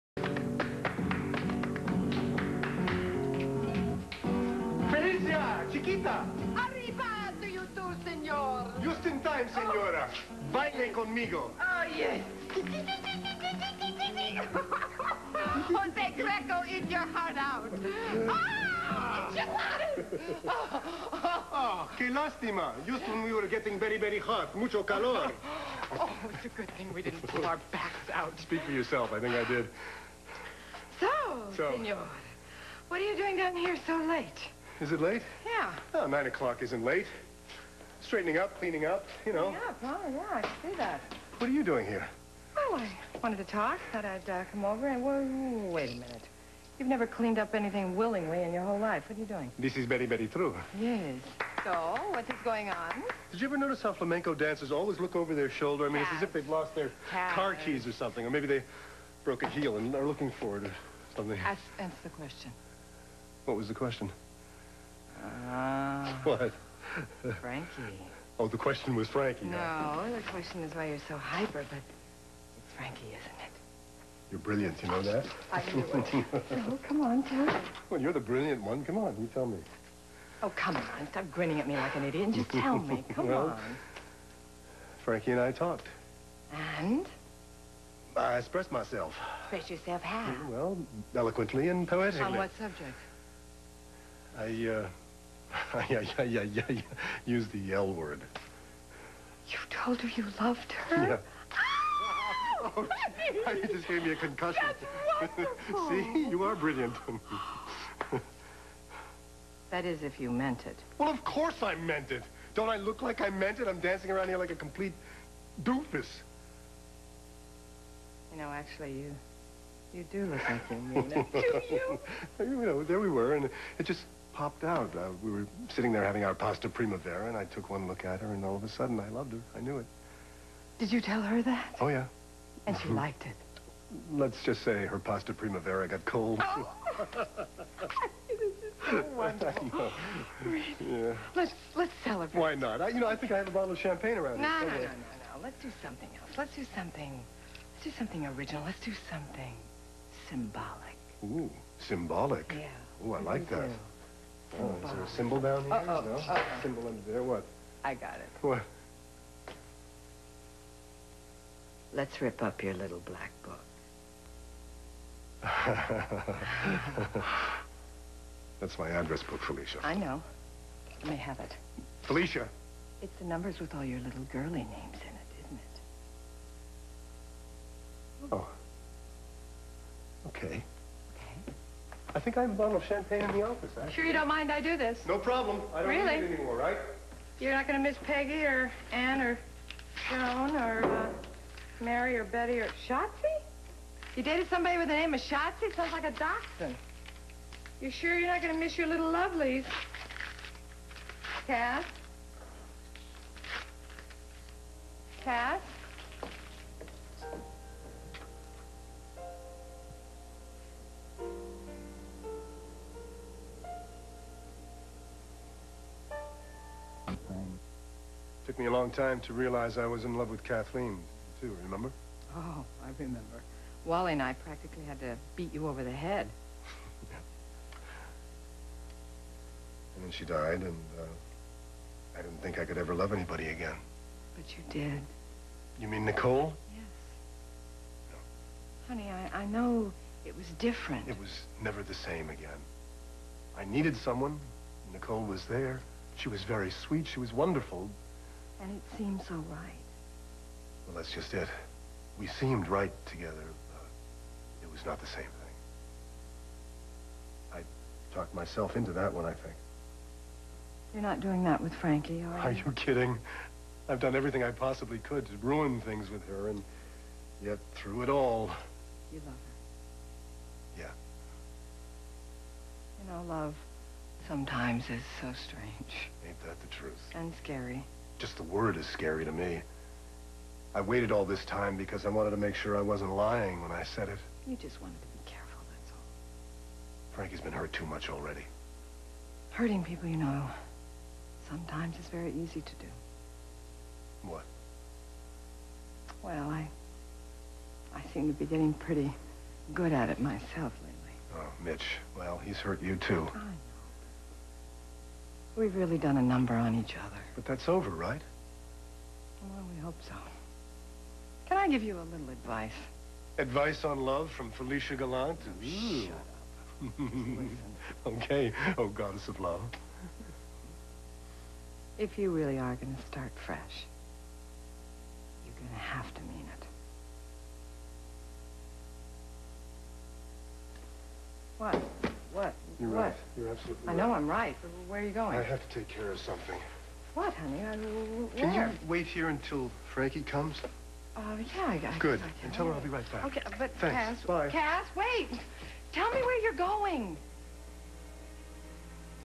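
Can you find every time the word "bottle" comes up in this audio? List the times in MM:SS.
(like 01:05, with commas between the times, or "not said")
02:23, 03:02.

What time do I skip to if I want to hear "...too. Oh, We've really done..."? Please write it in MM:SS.
05:02.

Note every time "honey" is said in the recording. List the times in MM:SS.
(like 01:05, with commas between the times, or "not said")
03:58, 05:37.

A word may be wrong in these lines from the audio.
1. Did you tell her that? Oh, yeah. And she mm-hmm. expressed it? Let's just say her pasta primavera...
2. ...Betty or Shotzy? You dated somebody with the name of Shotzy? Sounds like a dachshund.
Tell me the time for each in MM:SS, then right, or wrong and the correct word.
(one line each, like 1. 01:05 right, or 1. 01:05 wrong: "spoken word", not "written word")
1. 02:10 wrong: "liked", not "expressed"
2. 03:12 right.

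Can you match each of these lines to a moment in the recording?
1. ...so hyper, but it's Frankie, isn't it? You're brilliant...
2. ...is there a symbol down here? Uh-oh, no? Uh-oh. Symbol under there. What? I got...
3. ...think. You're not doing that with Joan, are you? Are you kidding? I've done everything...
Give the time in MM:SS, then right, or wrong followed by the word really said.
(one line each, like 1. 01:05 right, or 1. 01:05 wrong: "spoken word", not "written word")
1. 01:11 right
2. 02:34 right
3. 04:19 wrong: "Frankie", not "Joan".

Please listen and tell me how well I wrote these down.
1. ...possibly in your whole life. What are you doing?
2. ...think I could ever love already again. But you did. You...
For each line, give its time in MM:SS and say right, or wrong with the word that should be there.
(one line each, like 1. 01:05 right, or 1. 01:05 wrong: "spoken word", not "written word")
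1. 00:47 wrong: "willingly", not "possibly"
2. 03:52 wrong: "anybody", not "already".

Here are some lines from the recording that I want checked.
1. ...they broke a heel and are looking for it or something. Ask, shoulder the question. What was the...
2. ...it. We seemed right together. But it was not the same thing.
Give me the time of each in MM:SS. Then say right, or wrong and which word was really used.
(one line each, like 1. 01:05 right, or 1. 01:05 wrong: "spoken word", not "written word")
1. 00:58 wrong: "answer", not "shoulder"
2. 04:11 right.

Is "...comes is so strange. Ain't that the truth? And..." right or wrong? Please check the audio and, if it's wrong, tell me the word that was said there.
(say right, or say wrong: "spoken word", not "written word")
wrong: "sometimes", not "comes".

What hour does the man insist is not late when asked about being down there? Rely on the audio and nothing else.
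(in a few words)
9 o'clock.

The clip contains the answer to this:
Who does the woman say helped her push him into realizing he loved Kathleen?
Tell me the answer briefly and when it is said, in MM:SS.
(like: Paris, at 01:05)
Wally, at 03:43.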